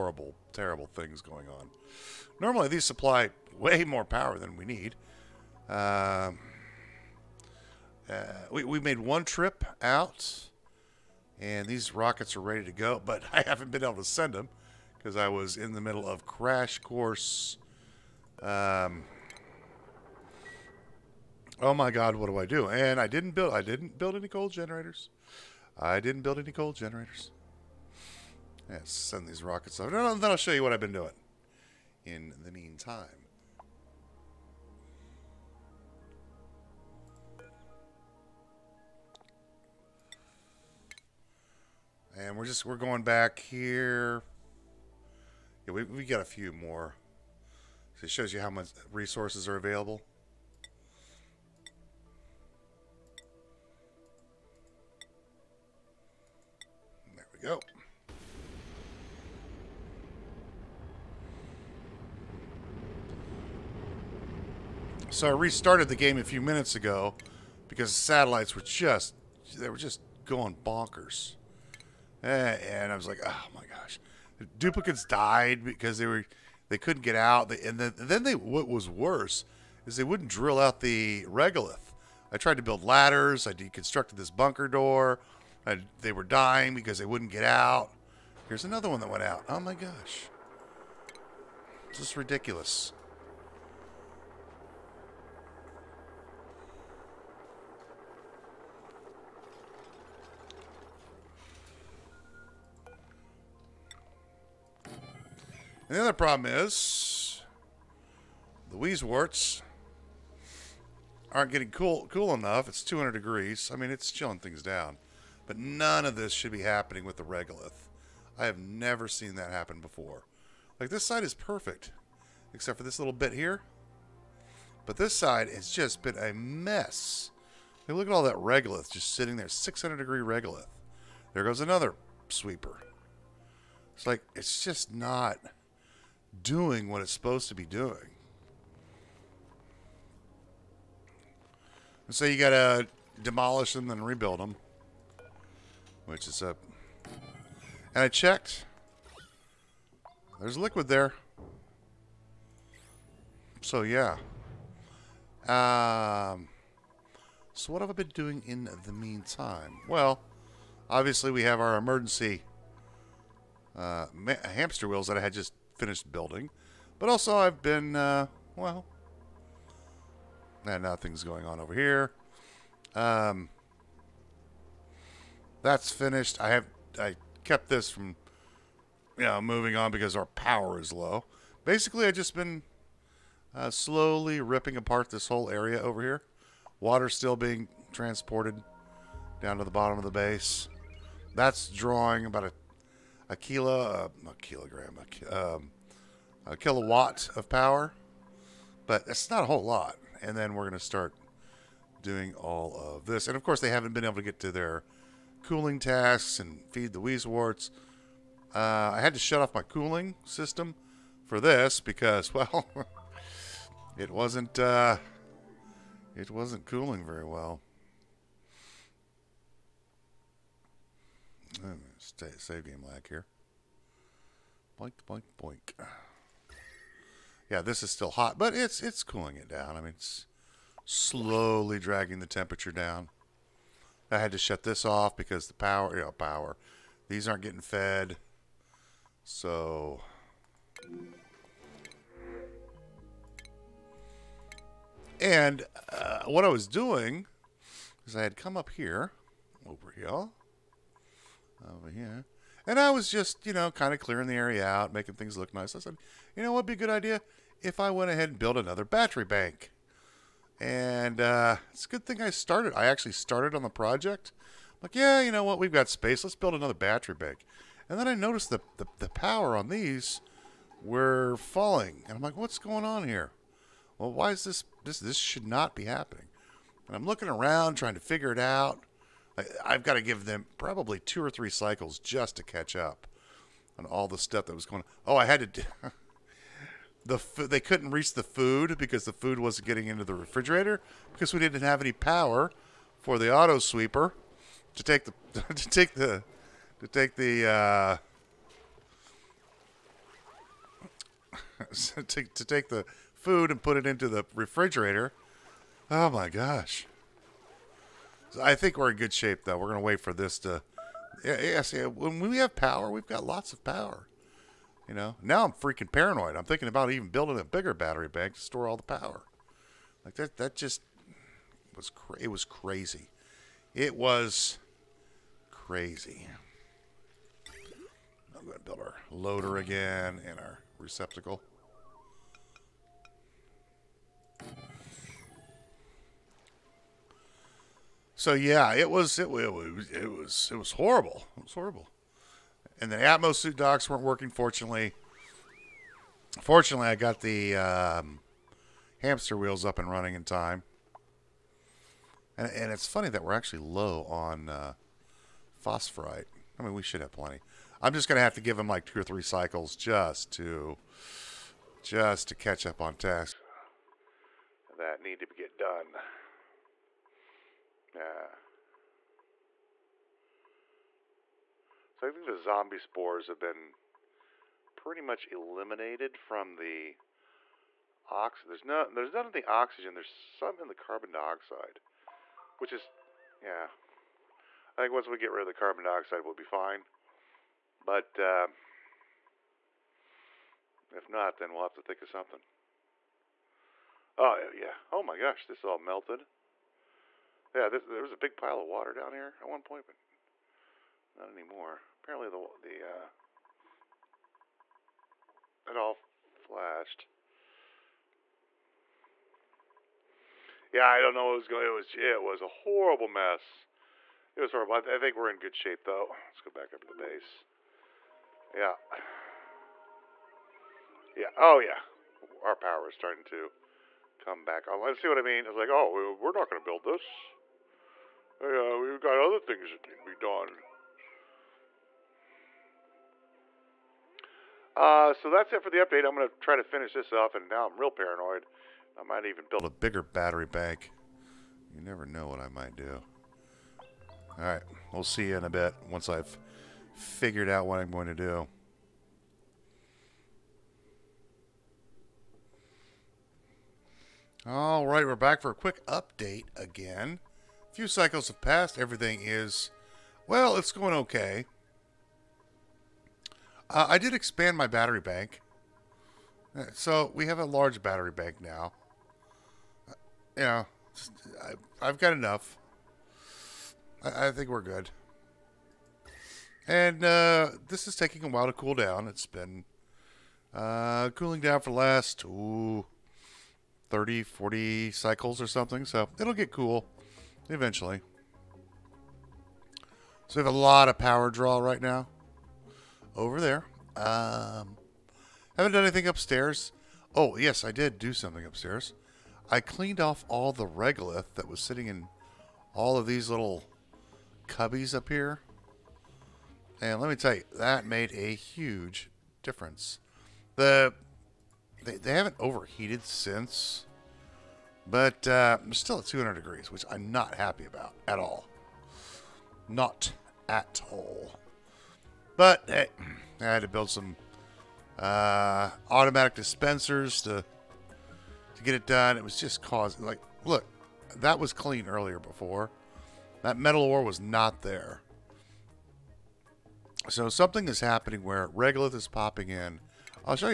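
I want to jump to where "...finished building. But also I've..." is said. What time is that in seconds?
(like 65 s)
165 s.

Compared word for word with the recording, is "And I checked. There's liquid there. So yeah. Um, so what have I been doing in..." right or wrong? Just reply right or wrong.
right.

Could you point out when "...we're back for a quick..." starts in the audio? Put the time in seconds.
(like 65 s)
455 s.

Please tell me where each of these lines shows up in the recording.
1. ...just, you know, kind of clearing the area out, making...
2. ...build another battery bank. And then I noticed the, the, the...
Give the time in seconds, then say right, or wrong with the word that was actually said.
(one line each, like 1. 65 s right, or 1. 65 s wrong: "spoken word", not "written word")
1. 253 s right
2. 266 s right.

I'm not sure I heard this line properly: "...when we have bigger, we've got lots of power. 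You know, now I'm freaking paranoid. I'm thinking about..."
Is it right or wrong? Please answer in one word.
wrong.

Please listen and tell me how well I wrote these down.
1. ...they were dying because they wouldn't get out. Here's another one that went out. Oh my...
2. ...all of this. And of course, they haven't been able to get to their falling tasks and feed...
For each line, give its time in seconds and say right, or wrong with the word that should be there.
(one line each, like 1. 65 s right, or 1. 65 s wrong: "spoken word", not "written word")
1. 86 s right
2. 202 s wrong: "cooling", not "falling".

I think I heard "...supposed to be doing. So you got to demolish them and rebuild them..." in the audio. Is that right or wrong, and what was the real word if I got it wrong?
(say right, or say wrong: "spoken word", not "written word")
right.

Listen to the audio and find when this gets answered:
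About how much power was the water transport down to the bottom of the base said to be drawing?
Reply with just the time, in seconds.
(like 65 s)
196 s.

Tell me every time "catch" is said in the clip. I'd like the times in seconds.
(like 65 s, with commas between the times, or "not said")
282 s, 362 s.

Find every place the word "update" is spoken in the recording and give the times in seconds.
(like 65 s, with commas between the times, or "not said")
435 s, 455 s.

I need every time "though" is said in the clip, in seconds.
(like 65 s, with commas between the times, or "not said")
309 s, 415 s.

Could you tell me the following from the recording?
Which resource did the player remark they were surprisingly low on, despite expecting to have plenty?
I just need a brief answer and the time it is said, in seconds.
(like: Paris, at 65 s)
Phosphorite, at 355 s.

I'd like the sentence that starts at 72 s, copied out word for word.
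Eh, and I was like, oh my gosh, the duplicates died because they were they couldn't get out.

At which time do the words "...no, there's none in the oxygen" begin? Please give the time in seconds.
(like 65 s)
378 s.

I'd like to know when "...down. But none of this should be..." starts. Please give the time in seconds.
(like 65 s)
114 s.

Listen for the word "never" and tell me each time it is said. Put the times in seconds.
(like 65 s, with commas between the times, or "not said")
118 s, 441 s.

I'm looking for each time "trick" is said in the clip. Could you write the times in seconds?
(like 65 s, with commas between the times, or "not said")
not said.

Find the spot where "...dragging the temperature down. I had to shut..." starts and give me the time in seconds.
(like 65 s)
231 s.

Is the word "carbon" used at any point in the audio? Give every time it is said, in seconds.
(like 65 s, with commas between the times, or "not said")
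380 s, 385 s.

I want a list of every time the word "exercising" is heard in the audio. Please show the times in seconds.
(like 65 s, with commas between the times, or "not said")
not said.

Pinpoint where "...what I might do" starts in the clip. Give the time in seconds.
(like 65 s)
442 s.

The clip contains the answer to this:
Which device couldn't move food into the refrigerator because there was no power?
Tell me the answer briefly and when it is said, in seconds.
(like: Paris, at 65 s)
Auto sweeper, at 293 s.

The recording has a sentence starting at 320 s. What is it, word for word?
Like that, that just was cra- it was crazy.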